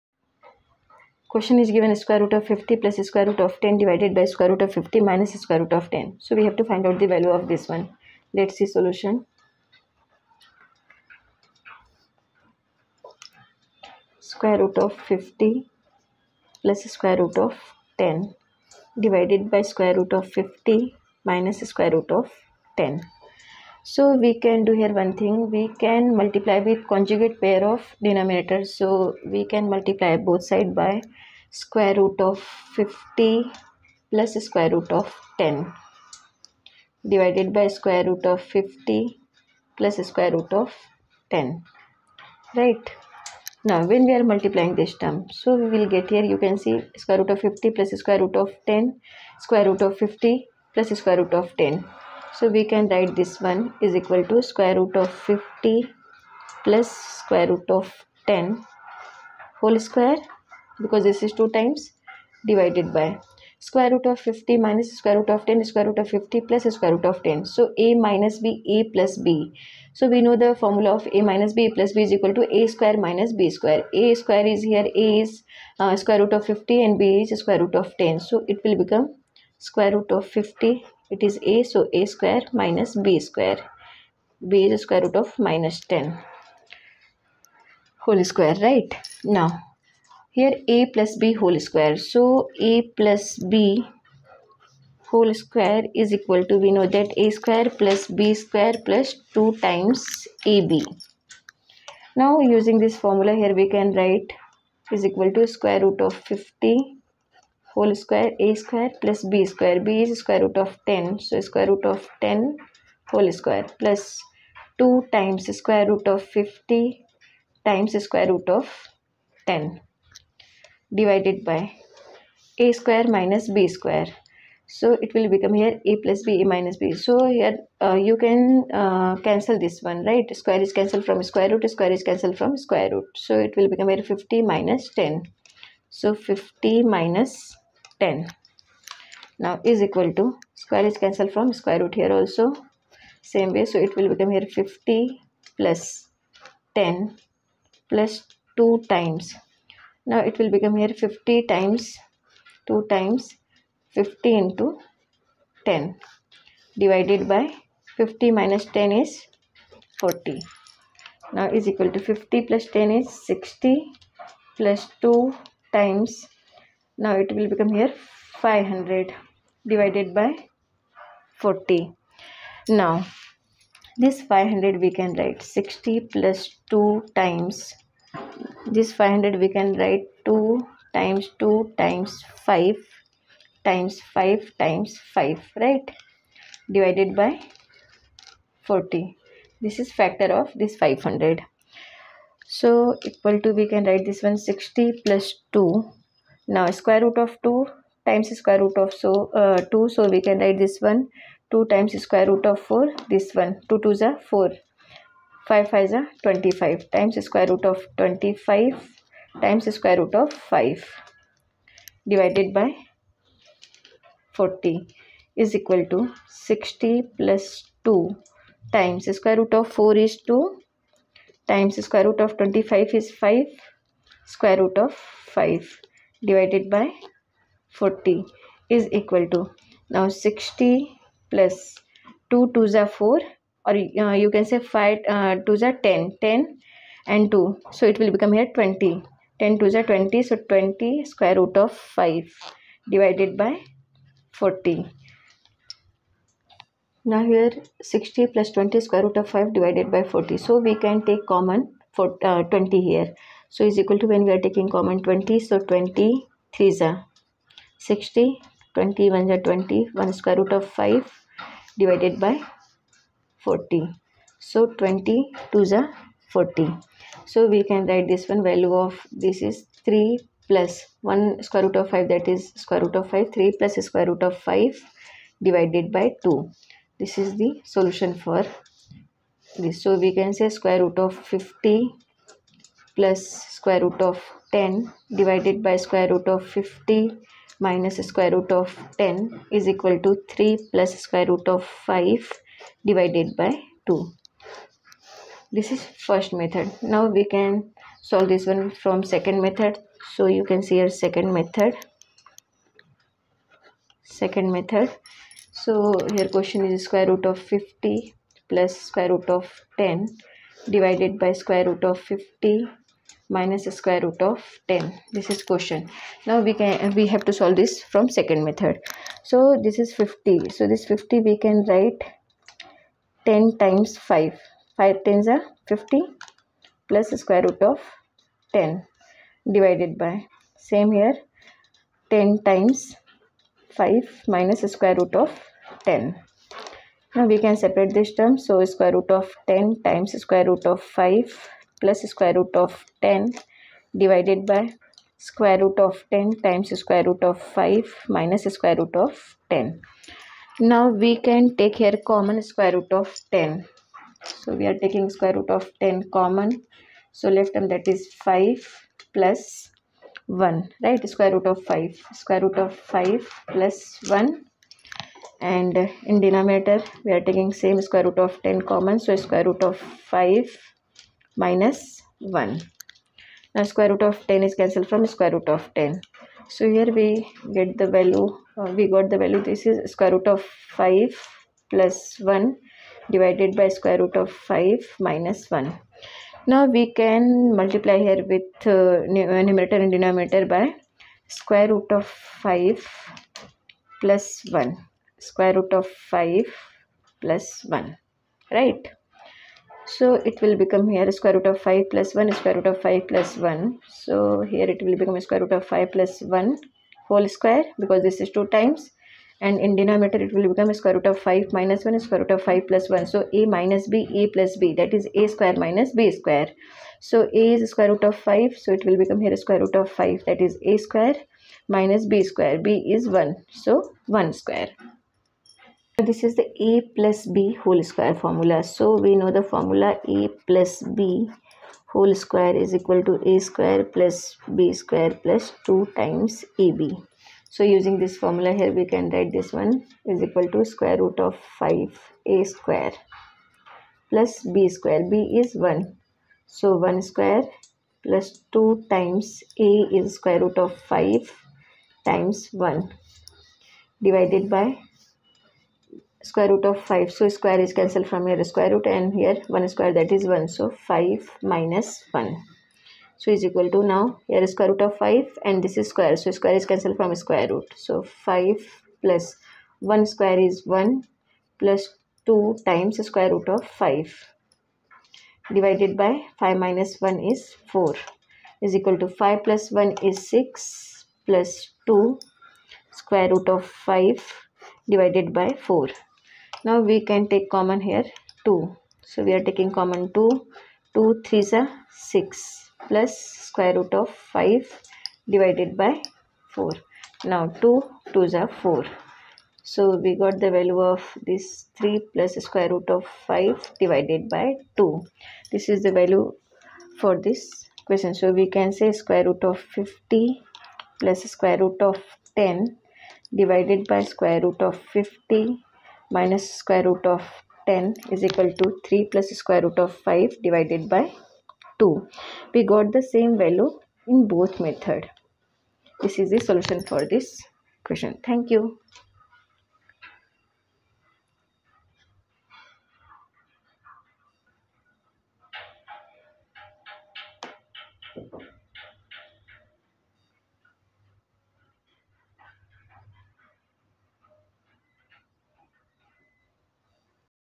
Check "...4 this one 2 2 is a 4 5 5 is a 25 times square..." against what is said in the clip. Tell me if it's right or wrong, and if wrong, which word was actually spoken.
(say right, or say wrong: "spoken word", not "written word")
right.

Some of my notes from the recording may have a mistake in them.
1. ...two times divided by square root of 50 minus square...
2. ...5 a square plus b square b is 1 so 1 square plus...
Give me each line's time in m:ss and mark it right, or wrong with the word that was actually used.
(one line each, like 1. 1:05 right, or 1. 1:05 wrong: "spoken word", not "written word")
1. 1:01 right
2. 7:21 right.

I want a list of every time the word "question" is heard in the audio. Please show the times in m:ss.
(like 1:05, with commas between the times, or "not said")
0:01, 5:06, 5:15, 8:27, 8:47.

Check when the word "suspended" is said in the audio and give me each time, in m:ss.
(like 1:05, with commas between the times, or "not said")
not said.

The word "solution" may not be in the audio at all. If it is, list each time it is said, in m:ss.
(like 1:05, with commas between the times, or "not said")
0:08, 4:37, 8:46.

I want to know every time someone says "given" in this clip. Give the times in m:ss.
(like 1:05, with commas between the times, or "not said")
0:01.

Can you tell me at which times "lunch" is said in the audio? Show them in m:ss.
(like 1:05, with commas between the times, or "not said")
not said.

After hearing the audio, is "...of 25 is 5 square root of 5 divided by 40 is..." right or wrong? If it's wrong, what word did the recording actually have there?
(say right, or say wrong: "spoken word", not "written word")
right.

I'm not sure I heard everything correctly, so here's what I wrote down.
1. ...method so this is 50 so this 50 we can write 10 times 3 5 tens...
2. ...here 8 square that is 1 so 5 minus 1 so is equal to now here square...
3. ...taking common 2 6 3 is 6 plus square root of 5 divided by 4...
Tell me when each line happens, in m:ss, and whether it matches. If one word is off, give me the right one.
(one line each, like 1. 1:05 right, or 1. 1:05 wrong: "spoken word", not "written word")
1. 5:18 wrong: "5", not "3"
2. 7:39 wrong: "1", not "8"
3. 8:09 wrong: "2", not "6".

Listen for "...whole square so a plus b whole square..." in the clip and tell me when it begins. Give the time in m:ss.
1:31.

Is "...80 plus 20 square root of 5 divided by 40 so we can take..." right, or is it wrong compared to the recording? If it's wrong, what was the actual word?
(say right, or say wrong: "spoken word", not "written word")
wrong: "60", not "80".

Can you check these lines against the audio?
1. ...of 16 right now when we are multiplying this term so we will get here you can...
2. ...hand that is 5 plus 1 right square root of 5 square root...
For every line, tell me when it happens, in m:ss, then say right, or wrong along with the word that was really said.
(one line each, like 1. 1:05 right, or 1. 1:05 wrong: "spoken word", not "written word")
1. 0:40 wrong: "10", not "16"
2. 5:57 right.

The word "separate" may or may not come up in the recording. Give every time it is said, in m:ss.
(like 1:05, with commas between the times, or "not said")
5:37.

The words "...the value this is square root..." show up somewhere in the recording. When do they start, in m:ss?
6:19.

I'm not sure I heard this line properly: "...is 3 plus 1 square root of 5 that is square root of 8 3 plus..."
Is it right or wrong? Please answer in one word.
wrong.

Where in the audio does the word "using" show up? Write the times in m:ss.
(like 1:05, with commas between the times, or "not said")
1:42, 7:17.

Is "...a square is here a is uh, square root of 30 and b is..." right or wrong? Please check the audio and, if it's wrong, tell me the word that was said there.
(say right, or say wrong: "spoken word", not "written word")
wrong: "50", not "30".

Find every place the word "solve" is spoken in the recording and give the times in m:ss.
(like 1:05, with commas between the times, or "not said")
4:58, 5:17.